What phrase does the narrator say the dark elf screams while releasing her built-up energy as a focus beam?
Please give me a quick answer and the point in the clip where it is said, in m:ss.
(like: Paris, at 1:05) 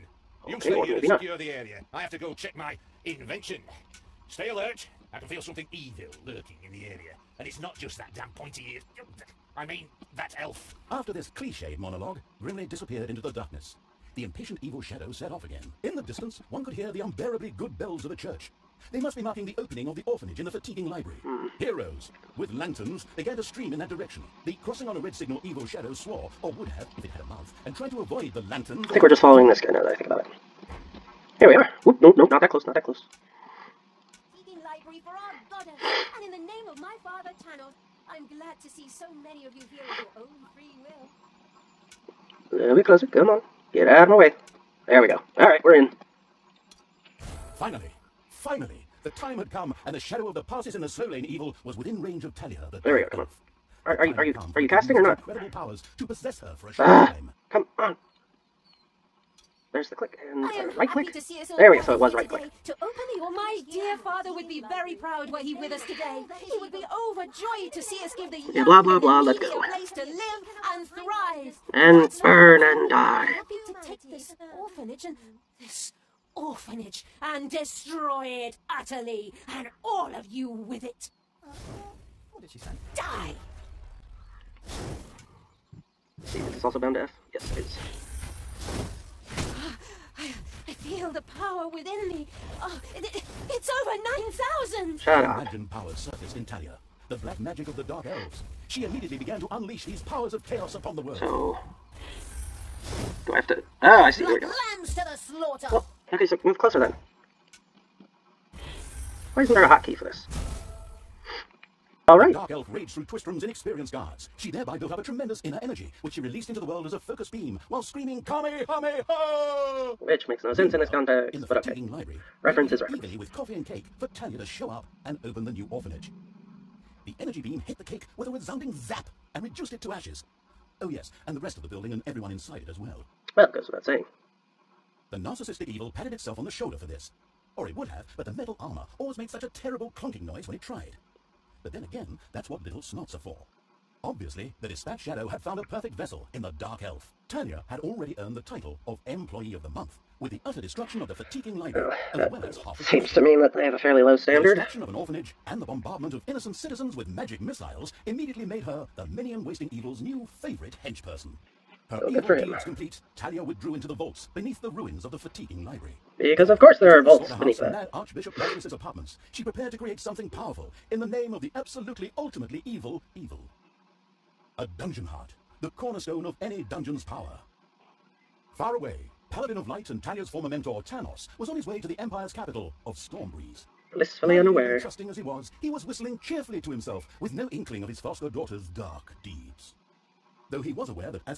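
Kamehameha, at 1:58.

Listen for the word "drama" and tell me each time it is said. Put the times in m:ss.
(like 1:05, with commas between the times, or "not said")
not said.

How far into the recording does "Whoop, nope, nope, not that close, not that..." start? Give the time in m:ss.
0:31.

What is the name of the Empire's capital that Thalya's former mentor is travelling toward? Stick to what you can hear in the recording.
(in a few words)
Stormbreeze.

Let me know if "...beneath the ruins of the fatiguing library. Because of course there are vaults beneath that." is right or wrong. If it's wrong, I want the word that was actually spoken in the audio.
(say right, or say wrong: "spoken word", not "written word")
right.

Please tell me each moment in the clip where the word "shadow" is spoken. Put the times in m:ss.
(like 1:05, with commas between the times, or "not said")
0:14, 0:25, 0:49, 2:24.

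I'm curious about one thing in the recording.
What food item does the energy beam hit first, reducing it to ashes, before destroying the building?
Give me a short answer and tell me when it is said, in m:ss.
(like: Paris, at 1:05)
the cake, at 2:07.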